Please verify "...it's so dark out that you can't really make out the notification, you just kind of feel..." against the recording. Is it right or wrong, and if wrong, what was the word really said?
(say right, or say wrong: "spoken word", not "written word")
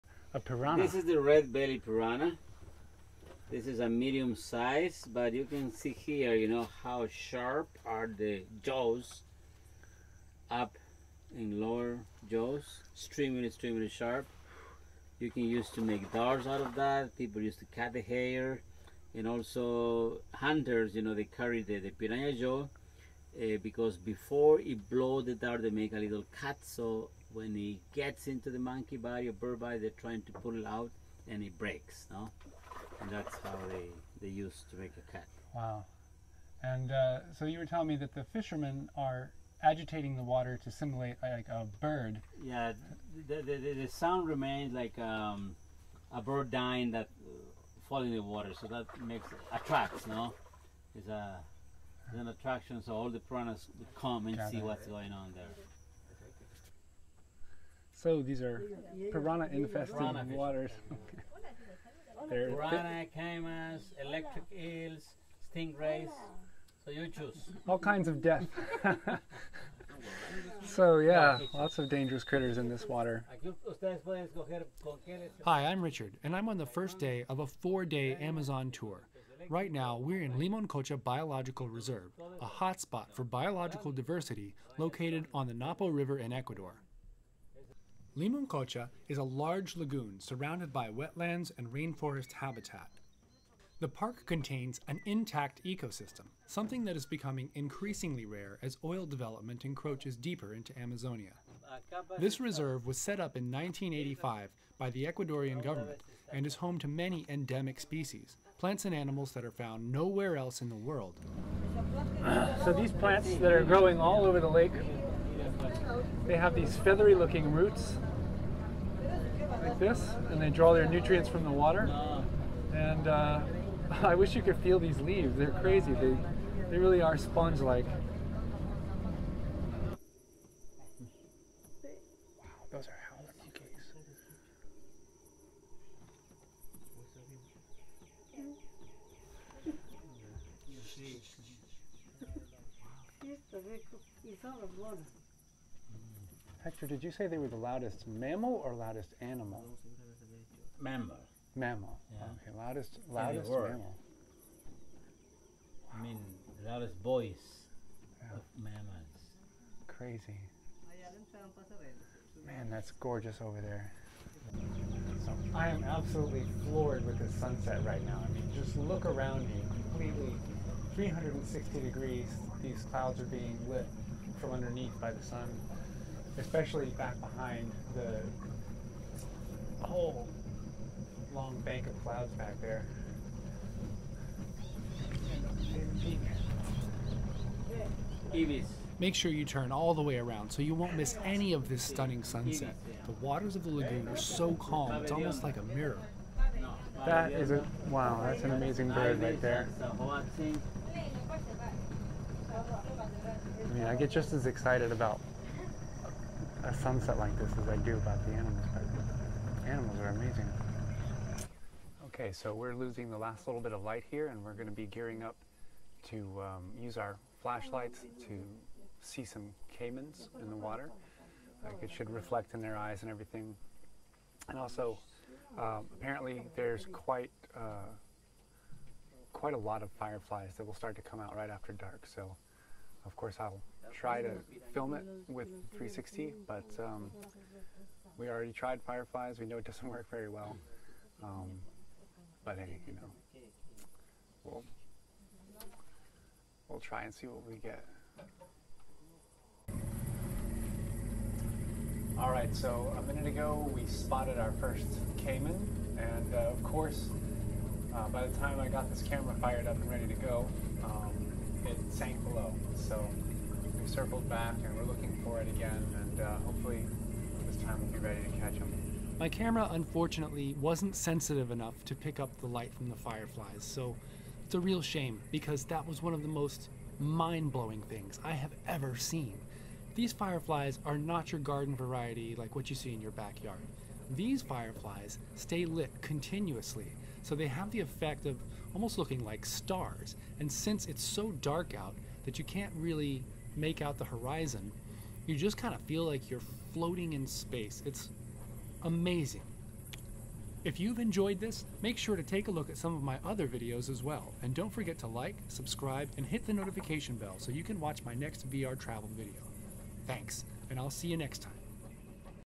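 wrong: "horizon", not "notification".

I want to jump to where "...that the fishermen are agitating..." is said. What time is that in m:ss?
0:37.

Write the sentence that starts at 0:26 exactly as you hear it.
So when he gets into the monkey body or bird body, they're trying to pull it out and it breaks, no?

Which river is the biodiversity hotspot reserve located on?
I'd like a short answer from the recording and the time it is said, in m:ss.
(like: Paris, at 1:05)
Napo River, at 1:25.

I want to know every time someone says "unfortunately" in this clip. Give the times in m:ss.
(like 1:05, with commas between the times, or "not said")
4:29.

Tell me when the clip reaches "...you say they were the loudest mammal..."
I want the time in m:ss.
2:27.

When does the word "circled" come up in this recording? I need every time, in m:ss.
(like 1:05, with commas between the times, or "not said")
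4:23.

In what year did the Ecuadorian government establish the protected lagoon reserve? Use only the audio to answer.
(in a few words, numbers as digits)
1985.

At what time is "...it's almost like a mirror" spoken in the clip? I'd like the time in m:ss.
3:15.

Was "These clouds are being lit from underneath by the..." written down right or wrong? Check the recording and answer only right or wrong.
right.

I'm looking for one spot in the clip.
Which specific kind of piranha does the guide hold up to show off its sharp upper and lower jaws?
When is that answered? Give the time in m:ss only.
0:01.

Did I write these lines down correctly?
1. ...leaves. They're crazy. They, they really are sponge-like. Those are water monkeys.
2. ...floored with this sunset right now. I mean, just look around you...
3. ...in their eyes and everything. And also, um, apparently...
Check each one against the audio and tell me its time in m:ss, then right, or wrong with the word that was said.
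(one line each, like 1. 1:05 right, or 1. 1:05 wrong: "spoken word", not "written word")
1. 2:04 wrong: "howler", not "water"
2. 2:46 right
3. 3:42 right.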